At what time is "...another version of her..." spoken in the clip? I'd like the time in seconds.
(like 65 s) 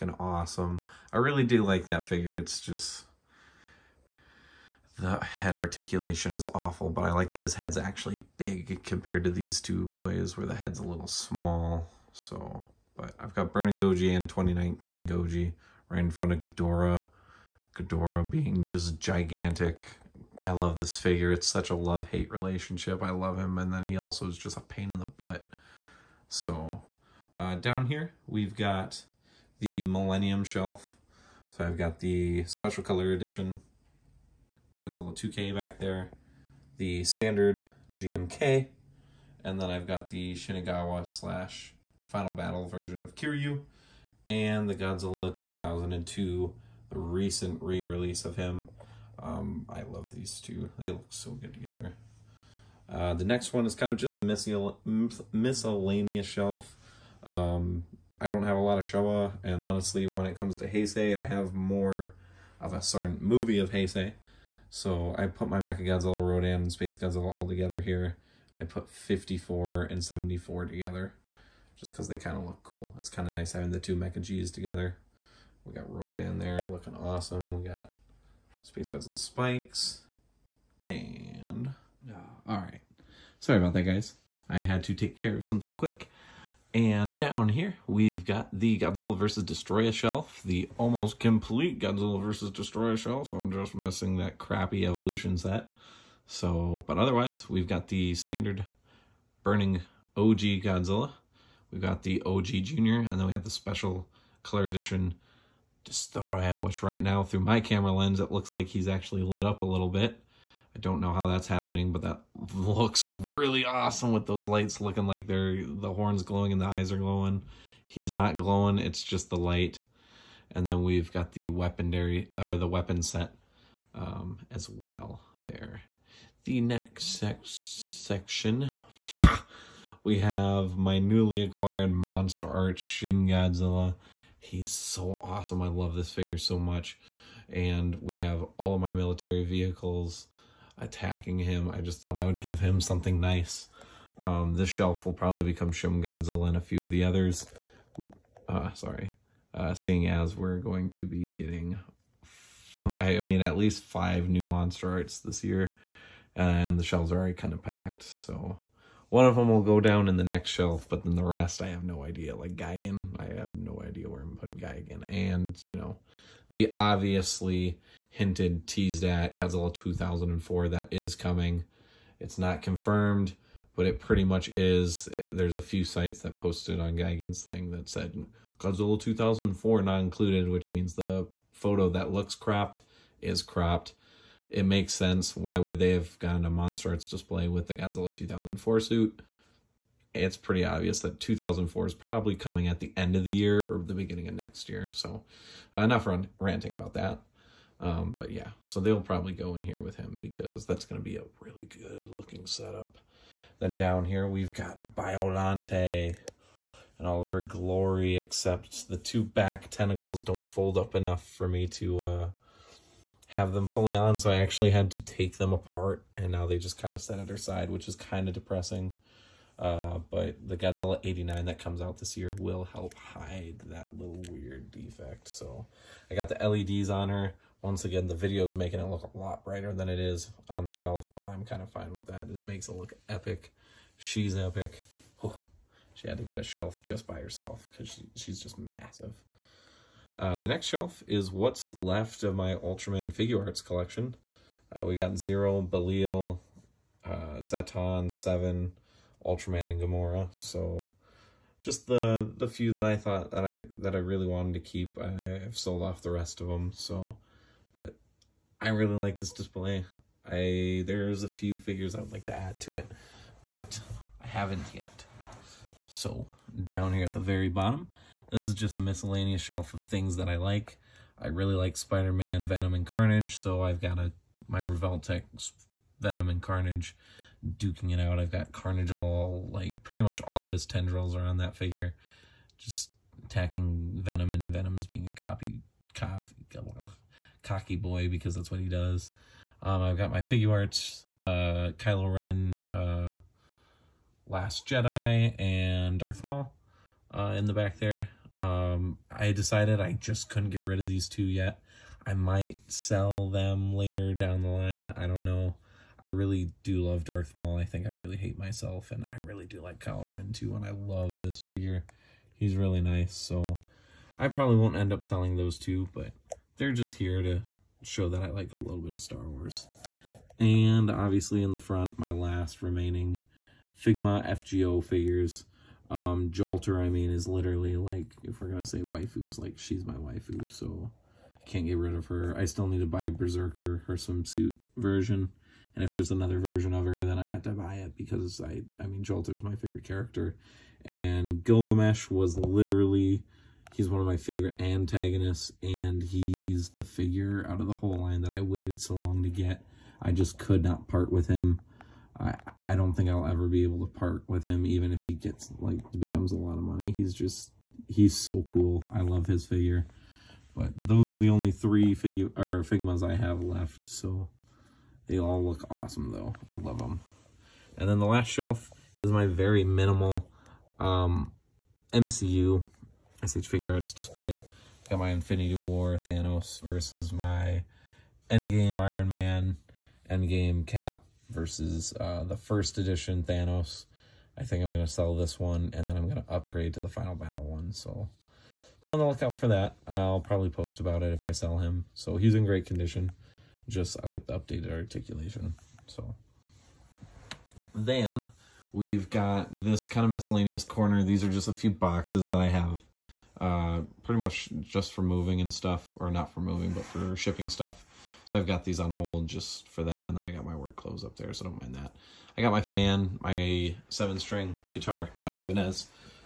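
336 s.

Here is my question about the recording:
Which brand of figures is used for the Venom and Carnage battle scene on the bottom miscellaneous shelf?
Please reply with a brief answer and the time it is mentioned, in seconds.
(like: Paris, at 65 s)
Revoltech, at 274 s.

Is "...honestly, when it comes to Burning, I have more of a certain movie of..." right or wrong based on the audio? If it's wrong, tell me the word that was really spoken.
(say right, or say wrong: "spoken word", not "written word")
wrong: "Heisei", not "Burning".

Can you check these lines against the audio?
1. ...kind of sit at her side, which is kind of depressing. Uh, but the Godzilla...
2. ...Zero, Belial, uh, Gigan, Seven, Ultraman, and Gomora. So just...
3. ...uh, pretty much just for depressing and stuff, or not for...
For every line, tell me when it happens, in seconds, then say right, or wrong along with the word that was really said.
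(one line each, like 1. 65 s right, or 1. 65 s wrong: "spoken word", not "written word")
1. 216 s right
2. 245 s wrong: "Zetton", not "Gigan"
3. 403 s wrong: "moving", not "depressing".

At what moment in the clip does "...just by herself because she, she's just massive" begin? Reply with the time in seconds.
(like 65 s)
236 s.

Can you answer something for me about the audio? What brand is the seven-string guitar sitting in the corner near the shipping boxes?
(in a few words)
Ibanez.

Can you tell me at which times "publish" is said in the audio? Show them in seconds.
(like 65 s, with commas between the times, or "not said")
not said.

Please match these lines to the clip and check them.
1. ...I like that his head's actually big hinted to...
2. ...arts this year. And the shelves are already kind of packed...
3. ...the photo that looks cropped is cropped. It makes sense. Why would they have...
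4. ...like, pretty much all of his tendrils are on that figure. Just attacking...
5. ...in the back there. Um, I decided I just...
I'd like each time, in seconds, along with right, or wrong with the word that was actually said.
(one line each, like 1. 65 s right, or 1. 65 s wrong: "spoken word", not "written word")
1. 7 s wrong: "compared", not "hinted"
2. 154 s right
3. 180 s right
4. 279 s right
5. 297 s right.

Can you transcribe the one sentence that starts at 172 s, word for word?
It's not confirmed, but it pretty much is.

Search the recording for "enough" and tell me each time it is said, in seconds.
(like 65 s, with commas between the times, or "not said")
195 s, 210 s.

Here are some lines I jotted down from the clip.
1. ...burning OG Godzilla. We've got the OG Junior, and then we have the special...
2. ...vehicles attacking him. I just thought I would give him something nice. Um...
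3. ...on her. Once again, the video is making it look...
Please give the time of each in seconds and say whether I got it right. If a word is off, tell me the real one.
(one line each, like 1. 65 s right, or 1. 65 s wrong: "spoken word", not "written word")
1. 99 s right
2. 139 s right
3. 226 s right.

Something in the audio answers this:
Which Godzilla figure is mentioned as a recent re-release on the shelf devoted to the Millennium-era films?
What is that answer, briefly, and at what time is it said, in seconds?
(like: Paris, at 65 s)
Godzilla 2002, at 44 s.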